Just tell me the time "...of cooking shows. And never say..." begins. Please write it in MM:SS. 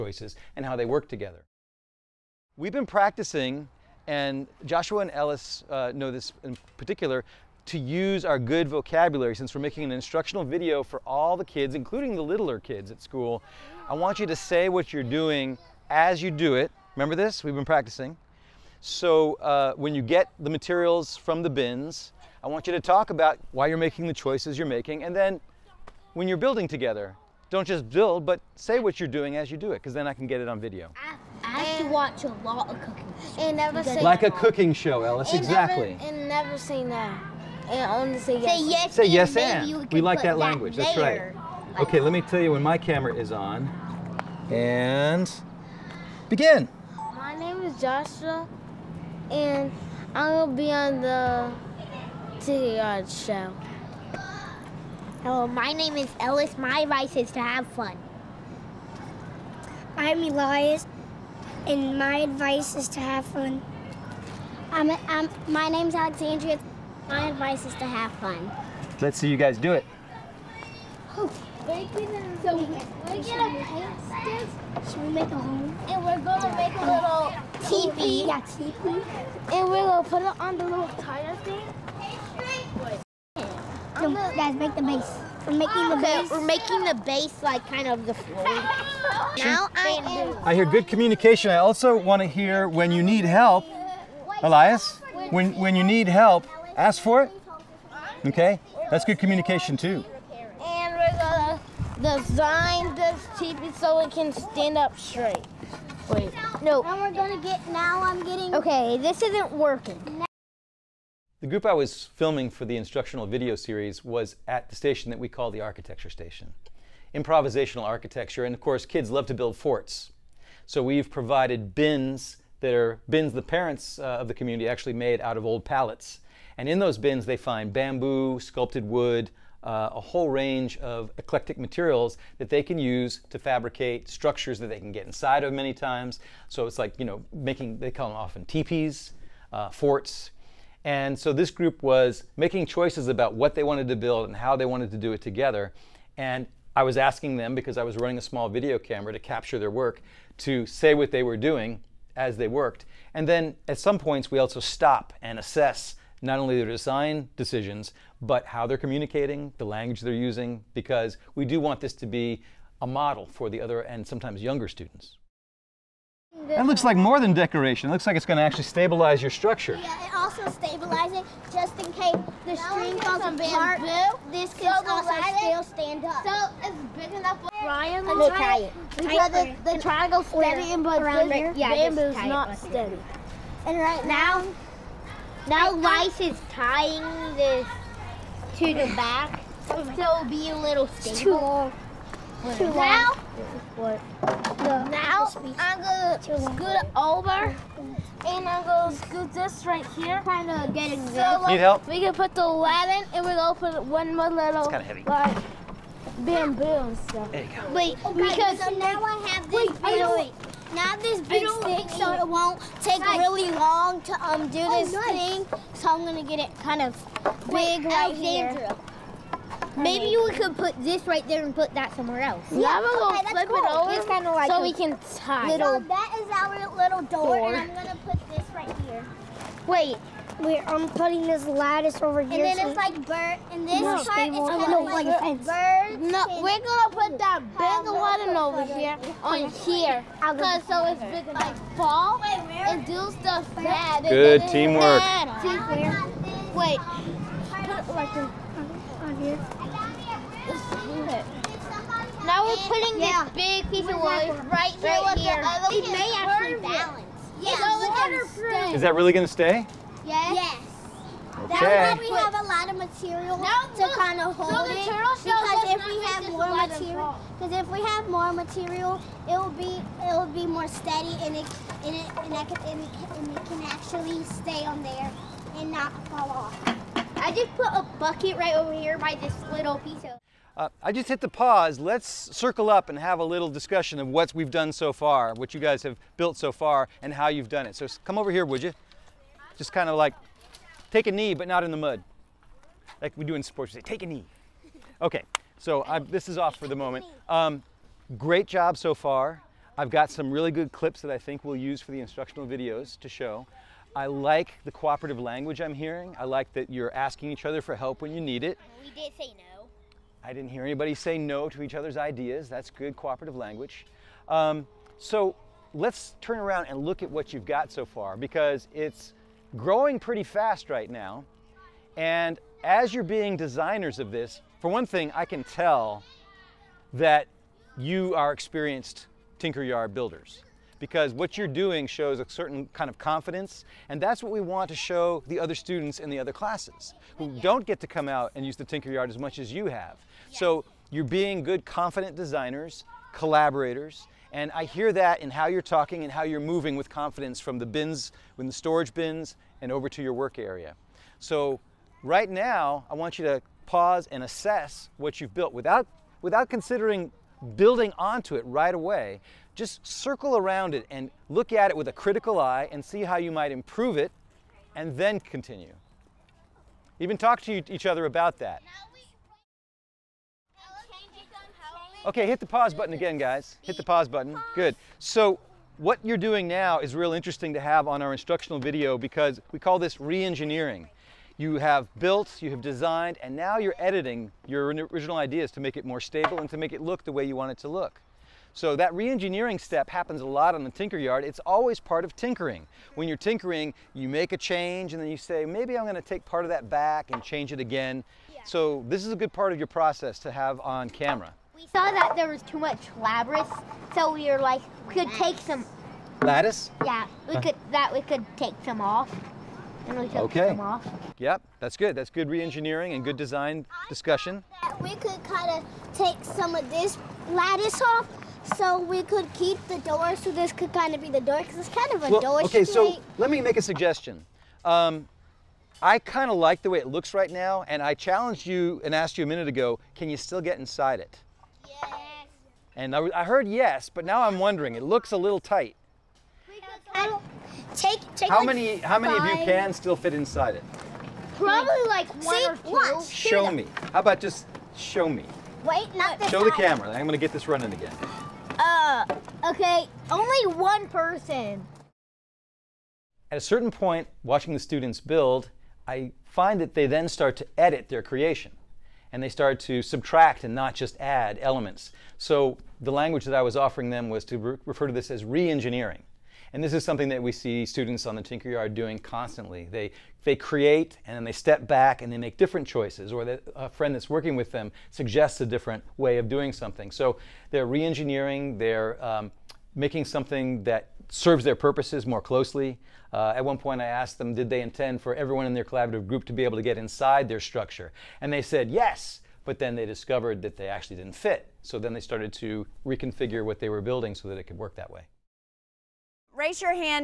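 00:32.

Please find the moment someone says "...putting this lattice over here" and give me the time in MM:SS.
03:50.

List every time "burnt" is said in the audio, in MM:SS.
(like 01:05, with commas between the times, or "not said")
not said.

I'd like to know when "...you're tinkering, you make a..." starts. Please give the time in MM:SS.
06:33.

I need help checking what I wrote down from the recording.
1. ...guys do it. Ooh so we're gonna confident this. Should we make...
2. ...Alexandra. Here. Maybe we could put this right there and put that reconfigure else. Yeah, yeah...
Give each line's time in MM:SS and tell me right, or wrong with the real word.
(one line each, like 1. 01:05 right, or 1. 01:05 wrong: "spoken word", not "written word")
1. 01:09 wrong: "paint", not "confident"
2. 03:38 wrong: "somewhere", not "reconfigure".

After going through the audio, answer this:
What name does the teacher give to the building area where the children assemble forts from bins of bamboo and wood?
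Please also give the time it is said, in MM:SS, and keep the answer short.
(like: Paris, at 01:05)
architecture station, at 01:55.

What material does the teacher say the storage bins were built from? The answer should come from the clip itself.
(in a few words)
old pallets.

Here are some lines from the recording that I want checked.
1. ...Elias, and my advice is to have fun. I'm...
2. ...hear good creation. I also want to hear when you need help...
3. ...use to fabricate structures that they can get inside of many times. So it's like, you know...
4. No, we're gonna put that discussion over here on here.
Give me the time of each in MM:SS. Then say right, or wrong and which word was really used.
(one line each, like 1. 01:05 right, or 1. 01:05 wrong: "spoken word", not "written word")
1. 01:00 right
2. 01:30 wrong: "communication", not "creation"
3. 02:12 right
4. 03:56 wrong: "button", not "discussion".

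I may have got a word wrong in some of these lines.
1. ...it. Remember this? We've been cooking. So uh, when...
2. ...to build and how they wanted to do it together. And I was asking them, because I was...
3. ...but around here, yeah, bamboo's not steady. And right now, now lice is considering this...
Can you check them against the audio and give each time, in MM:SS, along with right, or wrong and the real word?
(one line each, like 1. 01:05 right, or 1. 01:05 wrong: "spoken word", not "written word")
1. 00:16 wrong: "practicing", not "cooking"
2. 02:23 right
3. 03:00 wrong: "tying", not "considering".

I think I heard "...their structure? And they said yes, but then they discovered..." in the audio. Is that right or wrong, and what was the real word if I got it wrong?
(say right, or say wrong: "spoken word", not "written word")
right.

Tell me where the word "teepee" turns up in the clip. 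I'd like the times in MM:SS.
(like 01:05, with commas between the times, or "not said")
01:17, 02:18.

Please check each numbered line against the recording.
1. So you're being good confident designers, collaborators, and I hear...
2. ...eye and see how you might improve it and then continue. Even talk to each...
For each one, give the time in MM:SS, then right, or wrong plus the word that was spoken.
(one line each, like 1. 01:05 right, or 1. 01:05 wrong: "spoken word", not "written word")
1. 05:40 right
2. 06:02 right.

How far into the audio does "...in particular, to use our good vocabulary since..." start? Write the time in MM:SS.
00:06.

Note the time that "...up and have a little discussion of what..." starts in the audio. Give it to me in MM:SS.
04:42.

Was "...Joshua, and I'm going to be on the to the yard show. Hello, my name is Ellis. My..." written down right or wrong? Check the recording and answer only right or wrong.
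right.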